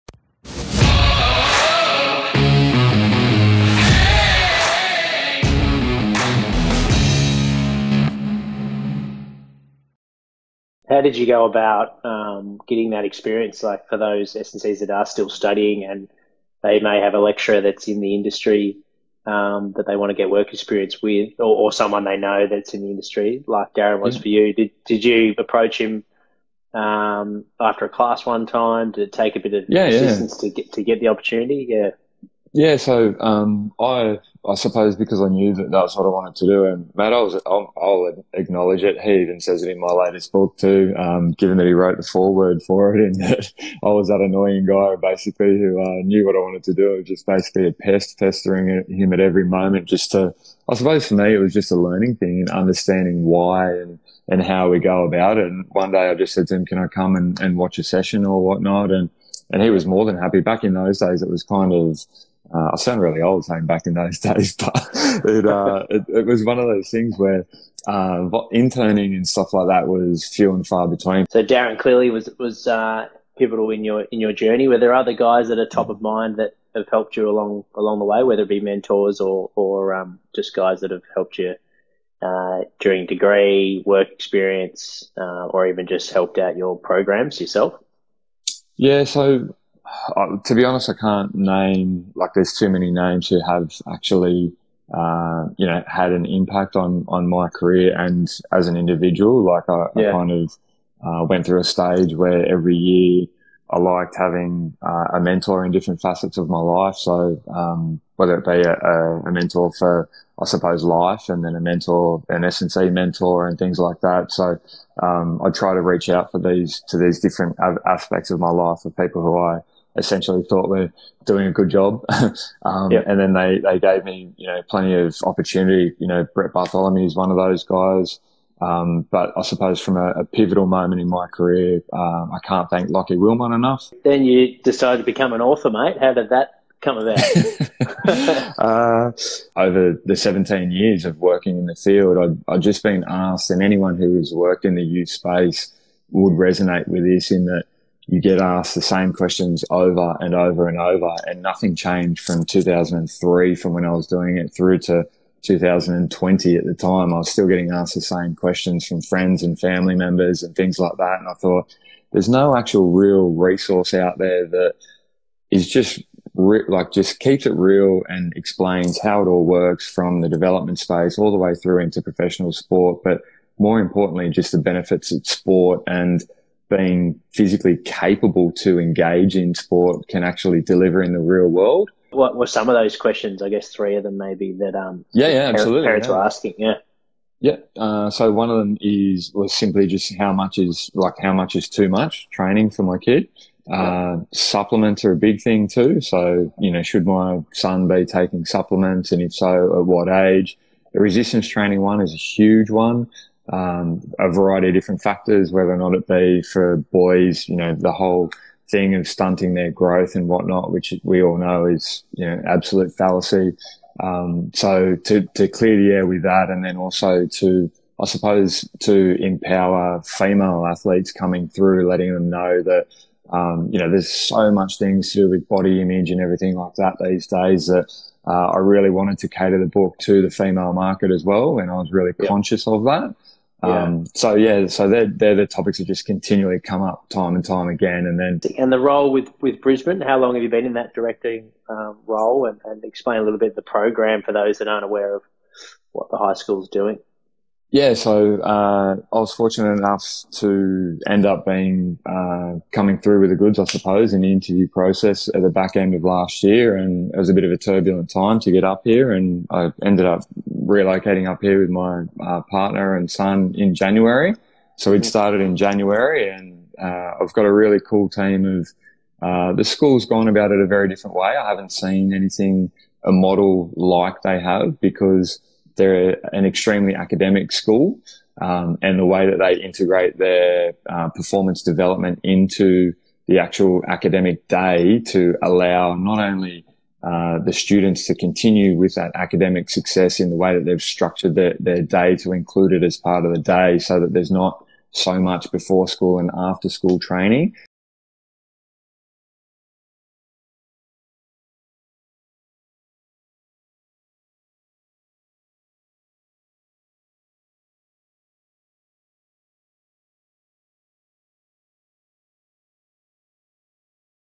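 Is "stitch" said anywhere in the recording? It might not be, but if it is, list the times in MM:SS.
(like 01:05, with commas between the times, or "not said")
not said.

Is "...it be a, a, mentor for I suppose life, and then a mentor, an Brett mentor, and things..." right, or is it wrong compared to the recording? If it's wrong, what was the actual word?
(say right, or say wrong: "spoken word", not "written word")
wrong: "SNC", not "Brett".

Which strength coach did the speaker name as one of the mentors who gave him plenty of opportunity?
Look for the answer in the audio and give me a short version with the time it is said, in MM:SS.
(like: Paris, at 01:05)
Brett Bartholomew, at 02:06.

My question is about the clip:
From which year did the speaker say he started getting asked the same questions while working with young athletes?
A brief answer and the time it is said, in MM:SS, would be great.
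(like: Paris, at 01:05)
2003, at 02:32.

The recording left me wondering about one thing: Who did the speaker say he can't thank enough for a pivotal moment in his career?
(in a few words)
Lockie Wilmot.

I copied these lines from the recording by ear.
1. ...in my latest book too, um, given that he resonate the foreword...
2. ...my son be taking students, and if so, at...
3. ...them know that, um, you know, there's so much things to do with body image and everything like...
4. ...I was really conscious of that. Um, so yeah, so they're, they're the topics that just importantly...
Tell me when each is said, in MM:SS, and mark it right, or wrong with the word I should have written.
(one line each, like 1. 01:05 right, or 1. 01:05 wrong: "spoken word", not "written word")
1. 00:39 wrong: "wrote", not "resonate"
2. 03:17 wrong: "supplements", not "students"
3. 03:42 right
4. 03:51 wrong: "continually", not "importantly".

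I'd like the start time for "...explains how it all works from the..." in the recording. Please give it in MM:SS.
02:48.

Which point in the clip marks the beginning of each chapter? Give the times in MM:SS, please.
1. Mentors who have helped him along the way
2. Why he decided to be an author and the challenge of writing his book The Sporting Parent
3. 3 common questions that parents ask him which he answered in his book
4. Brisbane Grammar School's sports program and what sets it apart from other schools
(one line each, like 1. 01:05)
1. 01:11
2. 02:14
3. 03:02
4. 03:59.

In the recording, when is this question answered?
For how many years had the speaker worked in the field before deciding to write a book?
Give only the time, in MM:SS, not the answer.
02:20.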